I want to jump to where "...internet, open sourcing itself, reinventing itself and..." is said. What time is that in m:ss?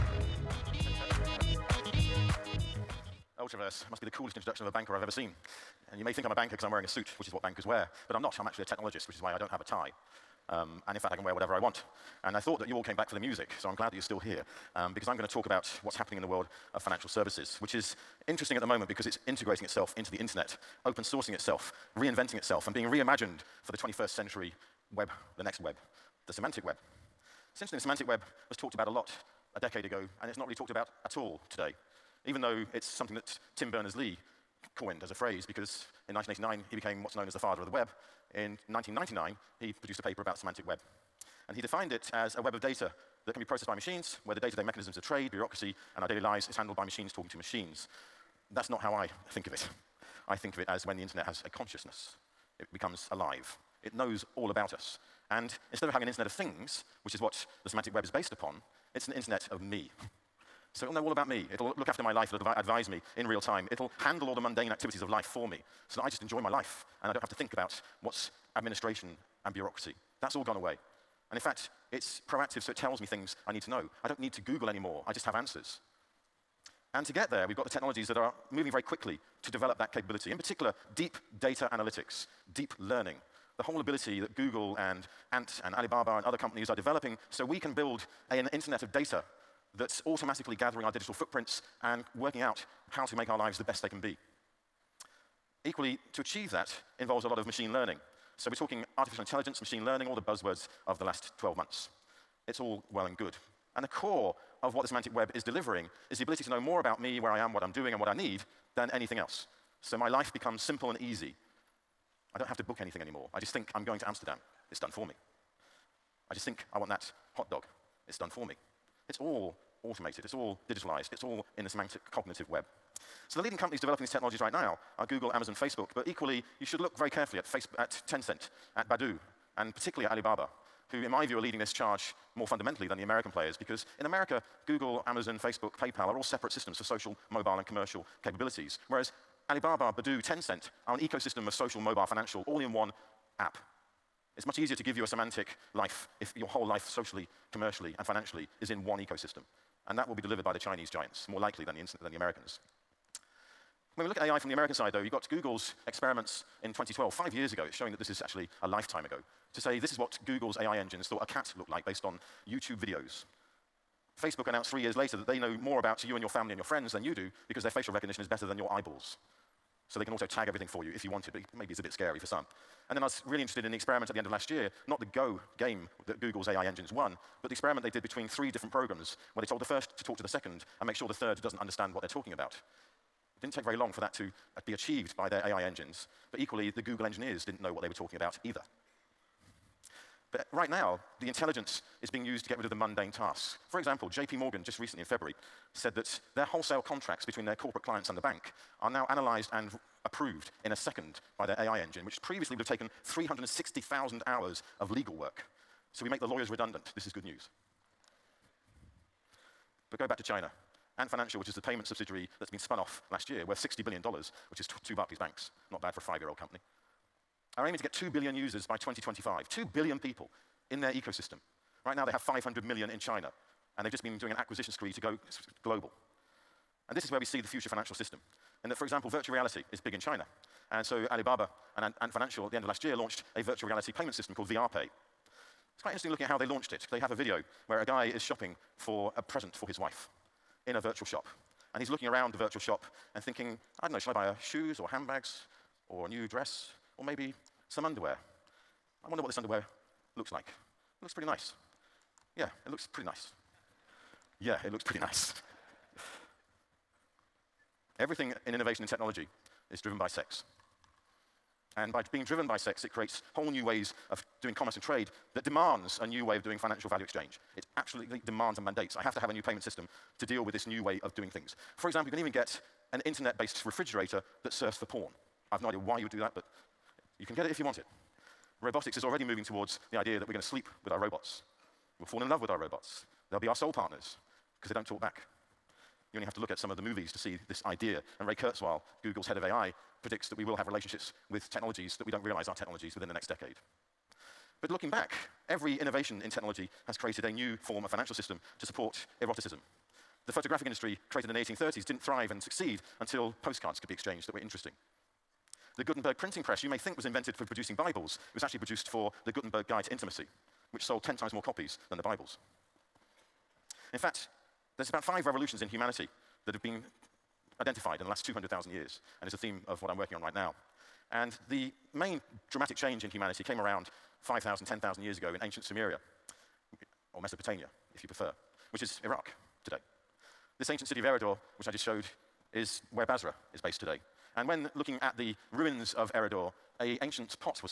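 0:20.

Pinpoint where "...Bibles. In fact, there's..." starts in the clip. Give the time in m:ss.
5:12.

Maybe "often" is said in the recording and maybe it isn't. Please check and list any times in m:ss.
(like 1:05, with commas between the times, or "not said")
not said.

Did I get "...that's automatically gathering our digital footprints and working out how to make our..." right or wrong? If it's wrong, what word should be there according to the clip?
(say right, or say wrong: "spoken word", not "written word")
right.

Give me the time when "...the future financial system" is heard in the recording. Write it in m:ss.
3:47.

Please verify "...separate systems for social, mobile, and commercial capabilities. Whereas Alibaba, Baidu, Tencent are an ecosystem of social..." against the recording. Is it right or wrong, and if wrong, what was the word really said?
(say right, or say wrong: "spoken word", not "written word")
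right.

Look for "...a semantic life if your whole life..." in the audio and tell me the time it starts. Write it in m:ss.
2:25.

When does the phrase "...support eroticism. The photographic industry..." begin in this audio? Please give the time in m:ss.
4:58.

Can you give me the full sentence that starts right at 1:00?
so it'll know all about me.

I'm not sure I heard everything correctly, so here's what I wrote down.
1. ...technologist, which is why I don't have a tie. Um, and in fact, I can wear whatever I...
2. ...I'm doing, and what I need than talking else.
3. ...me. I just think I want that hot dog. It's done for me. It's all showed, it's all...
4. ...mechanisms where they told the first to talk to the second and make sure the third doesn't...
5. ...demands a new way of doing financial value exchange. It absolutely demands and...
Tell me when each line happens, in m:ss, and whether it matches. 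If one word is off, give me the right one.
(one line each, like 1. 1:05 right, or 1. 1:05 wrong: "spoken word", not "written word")
1. 0:08 right
2. 1:47 wrong: "anything", not "talking"
3. 1:55 wrong: "automated", not "showed"
4. 2:58 wrong: "programs", not "mechanisms"
5. 4:25 right.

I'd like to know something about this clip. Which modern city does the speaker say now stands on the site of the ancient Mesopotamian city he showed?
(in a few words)
Basra.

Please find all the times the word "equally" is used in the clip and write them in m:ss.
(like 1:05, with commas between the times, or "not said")
1:35, 2:06, 3:06.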